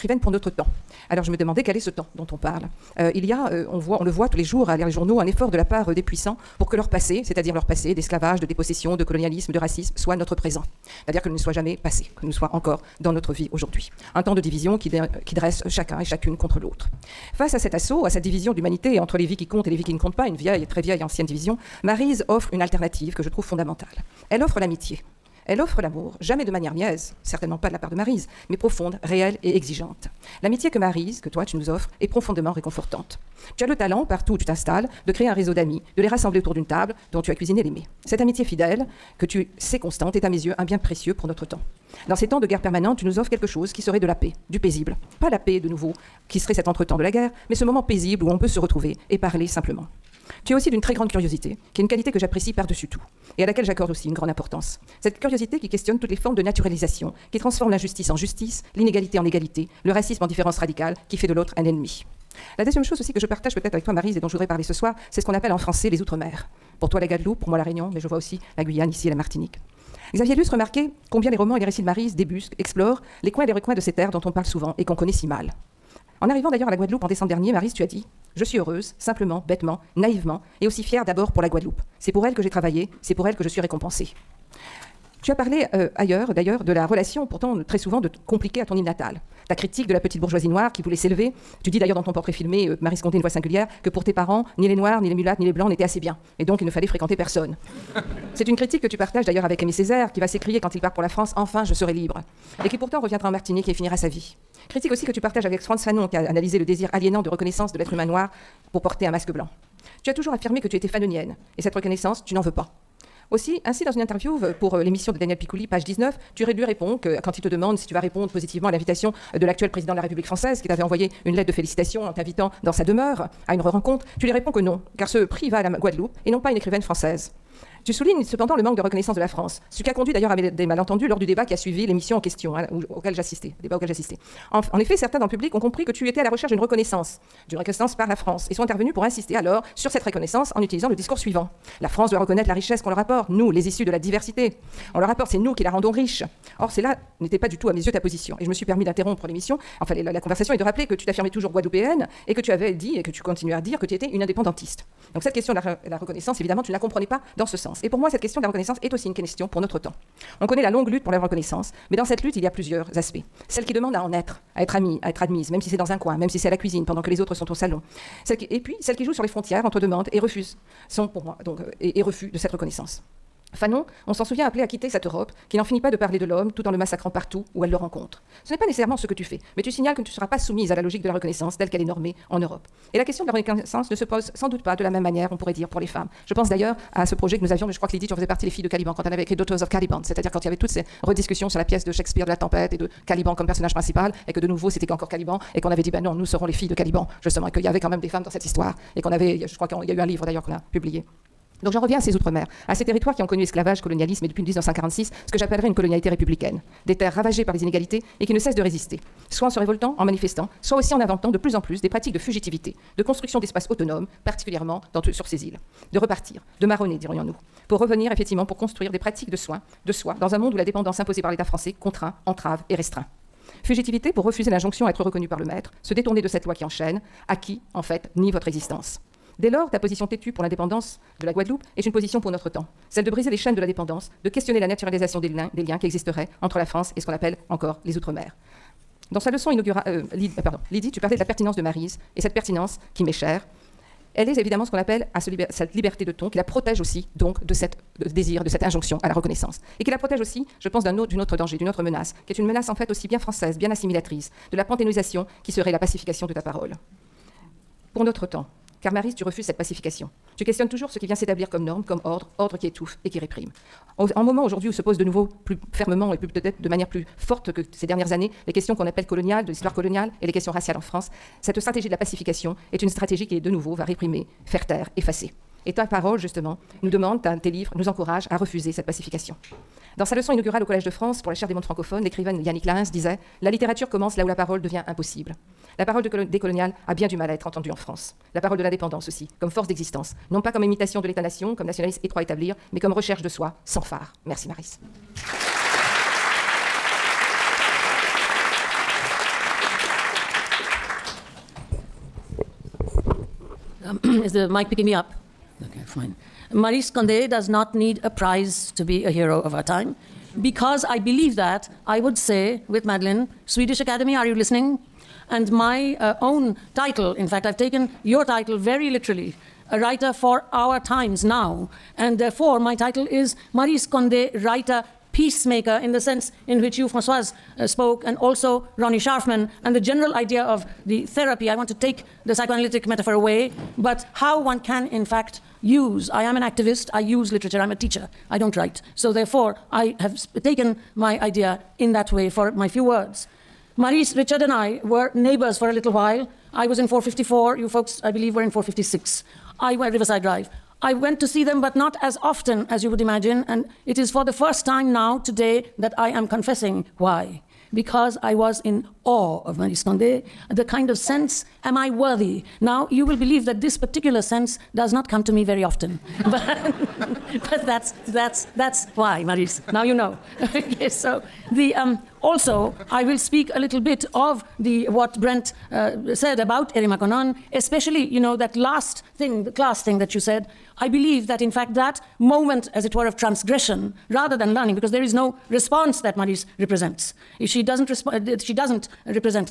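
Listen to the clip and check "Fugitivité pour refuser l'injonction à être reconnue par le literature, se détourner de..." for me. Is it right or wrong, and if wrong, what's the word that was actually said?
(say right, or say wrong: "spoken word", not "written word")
wrong: "maître", not "literature".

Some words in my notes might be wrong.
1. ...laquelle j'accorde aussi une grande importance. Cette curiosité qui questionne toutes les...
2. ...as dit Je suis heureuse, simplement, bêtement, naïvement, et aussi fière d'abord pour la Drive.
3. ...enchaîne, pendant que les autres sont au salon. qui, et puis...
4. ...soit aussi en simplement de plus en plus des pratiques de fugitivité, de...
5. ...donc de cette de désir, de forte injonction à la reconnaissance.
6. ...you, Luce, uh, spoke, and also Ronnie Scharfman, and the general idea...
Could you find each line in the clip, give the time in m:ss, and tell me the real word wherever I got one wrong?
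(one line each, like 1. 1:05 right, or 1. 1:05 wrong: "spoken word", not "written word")
1. 0:53 right
2. 1:17 wrong: "Guadeloupe", not "Drive"
3. 2:46 wrong: "cuisine", not "enchaîne"
4. 3:30 wrong: "inventant", not "simplement"
5. 4:07 wrong: "cette", not "forte"
6. 5:26 wrong: "Francoise", not "Luce".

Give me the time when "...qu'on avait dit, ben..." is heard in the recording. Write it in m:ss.
3:15.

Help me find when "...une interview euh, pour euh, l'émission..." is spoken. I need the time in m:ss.
1:53.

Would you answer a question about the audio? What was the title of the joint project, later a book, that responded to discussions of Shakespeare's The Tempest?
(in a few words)
Daughters of Caliban.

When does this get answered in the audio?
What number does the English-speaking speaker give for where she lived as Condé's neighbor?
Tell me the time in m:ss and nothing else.
5:46.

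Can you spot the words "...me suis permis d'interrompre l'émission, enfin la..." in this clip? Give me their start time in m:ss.
2:28.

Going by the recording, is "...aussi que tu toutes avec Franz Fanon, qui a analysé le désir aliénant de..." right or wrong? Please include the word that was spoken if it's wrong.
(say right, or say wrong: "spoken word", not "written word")
wrong: "partages", not "toutes".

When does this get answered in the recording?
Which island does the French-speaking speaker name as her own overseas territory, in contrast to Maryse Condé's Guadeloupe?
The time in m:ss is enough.
1:07.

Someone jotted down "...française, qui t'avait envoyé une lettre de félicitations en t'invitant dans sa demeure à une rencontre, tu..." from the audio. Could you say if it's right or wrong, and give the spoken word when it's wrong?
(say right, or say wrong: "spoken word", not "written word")
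right.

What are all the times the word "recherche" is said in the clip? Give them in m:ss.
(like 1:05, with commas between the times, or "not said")
2:16, 4:52.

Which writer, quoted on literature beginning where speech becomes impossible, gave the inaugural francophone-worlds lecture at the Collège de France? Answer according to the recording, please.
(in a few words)
Yannick Lahens.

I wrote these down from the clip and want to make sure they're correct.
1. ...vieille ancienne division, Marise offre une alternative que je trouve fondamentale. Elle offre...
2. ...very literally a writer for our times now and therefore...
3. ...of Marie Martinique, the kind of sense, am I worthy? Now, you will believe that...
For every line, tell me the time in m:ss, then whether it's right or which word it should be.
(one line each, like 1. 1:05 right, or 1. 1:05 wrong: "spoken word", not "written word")
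1. 0:20 right
2. 5:18 right
3. 5:59 wrong: "Condé", not "Martinique".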